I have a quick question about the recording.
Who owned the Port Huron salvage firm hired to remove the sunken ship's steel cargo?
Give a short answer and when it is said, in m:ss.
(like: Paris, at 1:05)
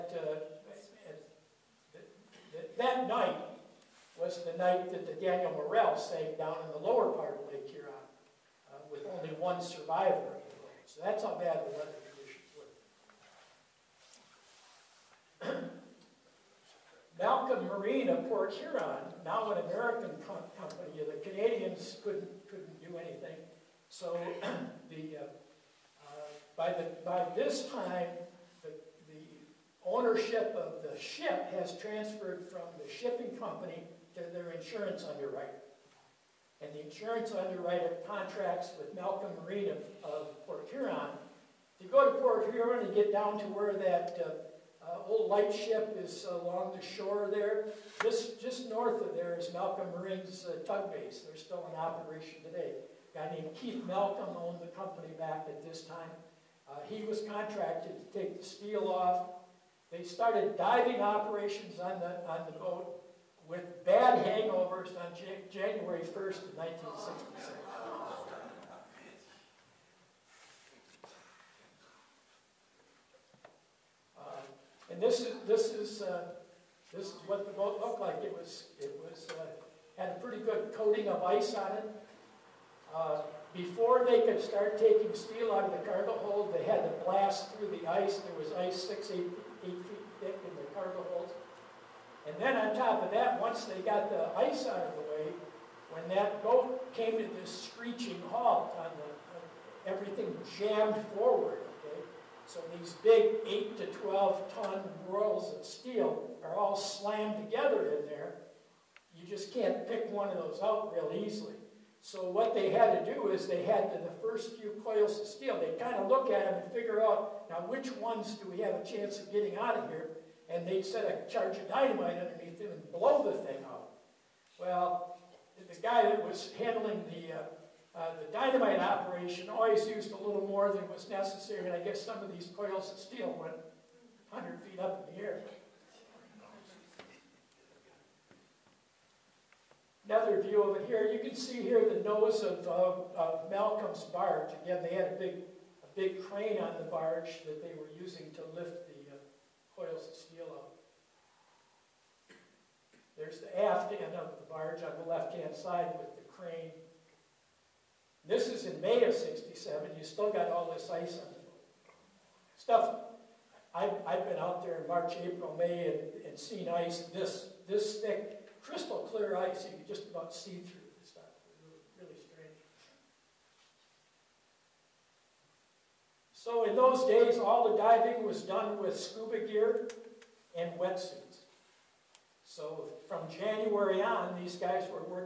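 Keith Malcolm, at 0:53.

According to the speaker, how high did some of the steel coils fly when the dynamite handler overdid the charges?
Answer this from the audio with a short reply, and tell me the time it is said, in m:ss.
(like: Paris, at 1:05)
100 feet, at 2:14.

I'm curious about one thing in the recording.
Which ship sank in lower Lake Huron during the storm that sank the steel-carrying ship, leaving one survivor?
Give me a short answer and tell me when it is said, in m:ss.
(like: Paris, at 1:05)
Daniel Morrell, at 0:05.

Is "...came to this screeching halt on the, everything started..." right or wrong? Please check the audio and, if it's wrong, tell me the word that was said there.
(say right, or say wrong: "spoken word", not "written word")
wrong: "jammed", not "started".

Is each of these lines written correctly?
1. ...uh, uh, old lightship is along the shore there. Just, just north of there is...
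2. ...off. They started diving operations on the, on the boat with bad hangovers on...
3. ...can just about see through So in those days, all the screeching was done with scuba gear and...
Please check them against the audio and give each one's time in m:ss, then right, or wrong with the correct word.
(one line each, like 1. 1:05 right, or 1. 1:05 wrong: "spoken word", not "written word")
1. 0:44 right
2. 0:58 right
3. 2:49 wrong: "diving", not "screeching".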